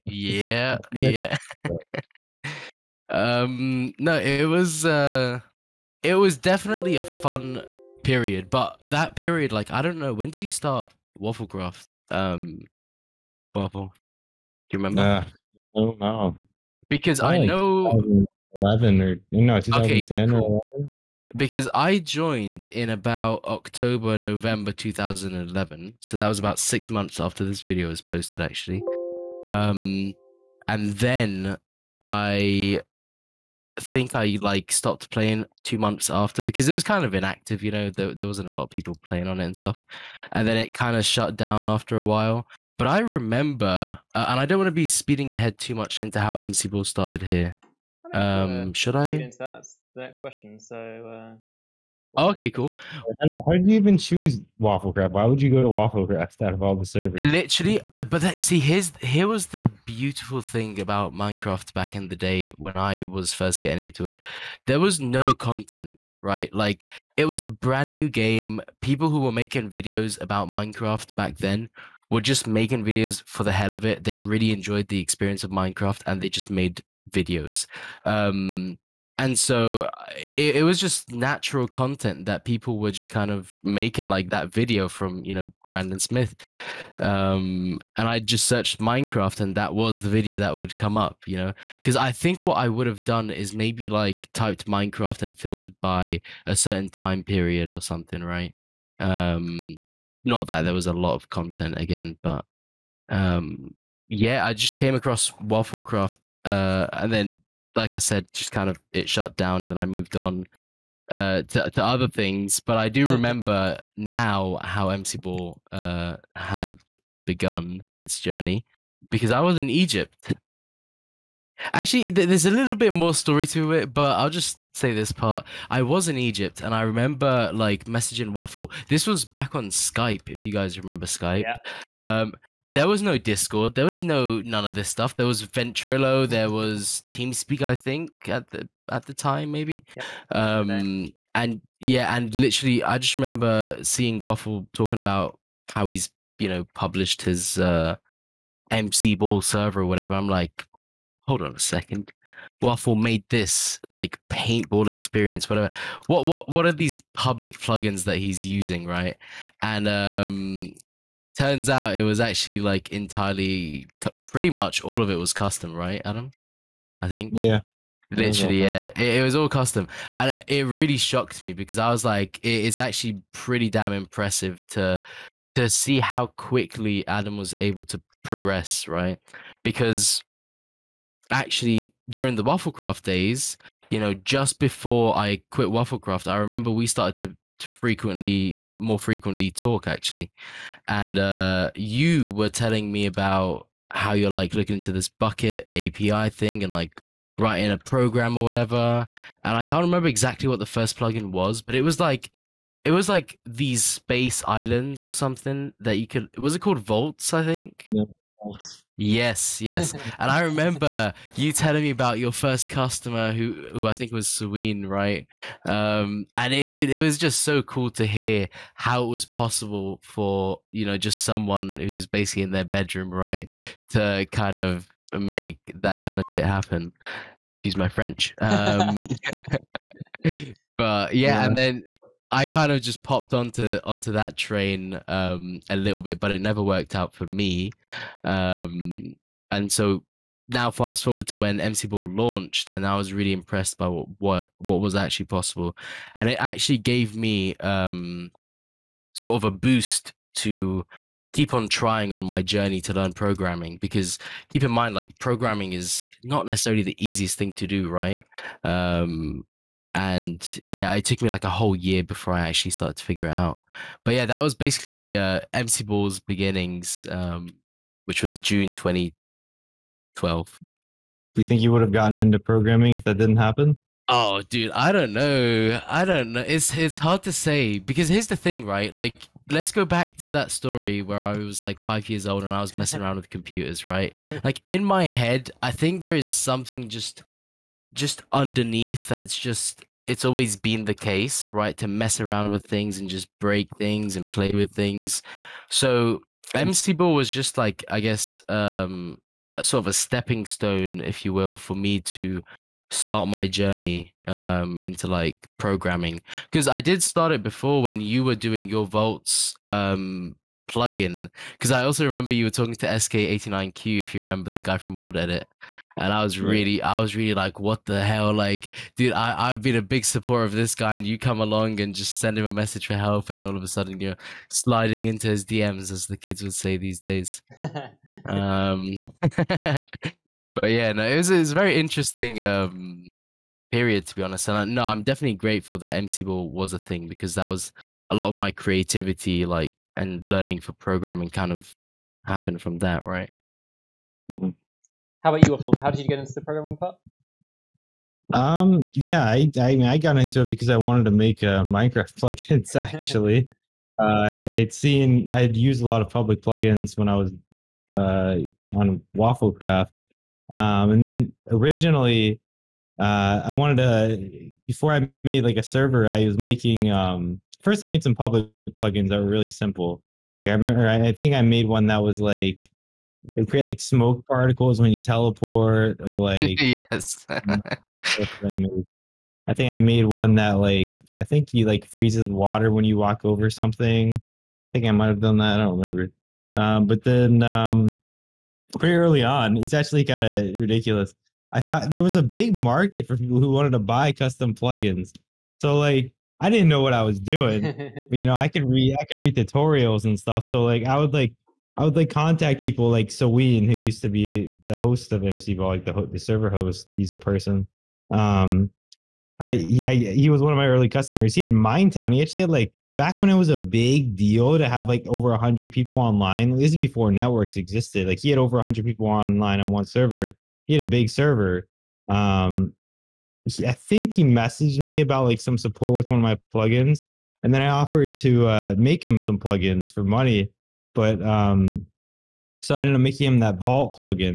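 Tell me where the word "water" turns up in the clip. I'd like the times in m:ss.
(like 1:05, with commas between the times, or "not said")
6:22.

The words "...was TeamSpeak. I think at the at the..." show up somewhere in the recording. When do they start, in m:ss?
2:16.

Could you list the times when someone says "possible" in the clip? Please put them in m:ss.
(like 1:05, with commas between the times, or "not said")
3:39, 4:05.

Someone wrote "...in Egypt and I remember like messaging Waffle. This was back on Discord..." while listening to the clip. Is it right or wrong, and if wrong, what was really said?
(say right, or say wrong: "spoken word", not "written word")
wrong: "Skype", not "Discord".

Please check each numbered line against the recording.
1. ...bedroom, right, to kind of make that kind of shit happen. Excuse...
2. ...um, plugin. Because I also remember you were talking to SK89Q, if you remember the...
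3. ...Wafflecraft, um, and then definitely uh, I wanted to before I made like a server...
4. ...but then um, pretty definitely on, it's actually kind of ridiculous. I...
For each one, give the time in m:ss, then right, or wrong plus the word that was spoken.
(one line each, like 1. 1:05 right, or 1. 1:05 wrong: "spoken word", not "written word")
1. 3:42 right
2. 5:09 right
3. 5:59 wrong: "originally", not "definitely"
4. 6:26 wrong: "early", not "definitely".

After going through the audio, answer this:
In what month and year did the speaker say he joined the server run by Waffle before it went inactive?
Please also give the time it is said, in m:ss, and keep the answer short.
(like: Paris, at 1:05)
October 2011, at 0:23.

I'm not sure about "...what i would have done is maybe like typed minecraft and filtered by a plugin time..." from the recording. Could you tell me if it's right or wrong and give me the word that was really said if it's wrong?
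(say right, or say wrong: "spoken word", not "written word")
wrong: "certain", not "plugin".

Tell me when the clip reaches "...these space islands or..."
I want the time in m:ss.
3:23.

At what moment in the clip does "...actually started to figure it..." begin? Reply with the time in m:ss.
4:22.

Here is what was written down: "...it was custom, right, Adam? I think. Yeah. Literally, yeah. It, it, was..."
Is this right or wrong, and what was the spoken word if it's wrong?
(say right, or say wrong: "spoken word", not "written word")
right.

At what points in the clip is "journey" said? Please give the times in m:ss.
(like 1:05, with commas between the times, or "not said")
1:58, 4:12, 5:03.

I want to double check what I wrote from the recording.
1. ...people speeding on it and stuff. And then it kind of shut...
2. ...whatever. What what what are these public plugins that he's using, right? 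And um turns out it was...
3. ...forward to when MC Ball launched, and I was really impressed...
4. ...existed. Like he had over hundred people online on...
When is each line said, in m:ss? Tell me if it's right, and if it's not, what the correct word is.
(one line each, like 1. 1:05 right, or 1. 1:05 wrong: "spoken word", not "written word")
1. 0:38 wrong: "playing", not "speeding"
2. 2:35 right
3. 4:01 right
4. 6:57 right.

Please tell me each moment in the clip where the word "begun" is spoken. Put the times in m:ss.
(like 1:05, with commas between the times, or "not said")
1:57.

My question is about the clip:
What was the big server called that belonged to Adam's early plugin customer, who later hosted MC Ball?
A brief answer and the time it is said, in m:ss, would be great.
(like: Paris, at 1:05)
Mindtown, at 6:51.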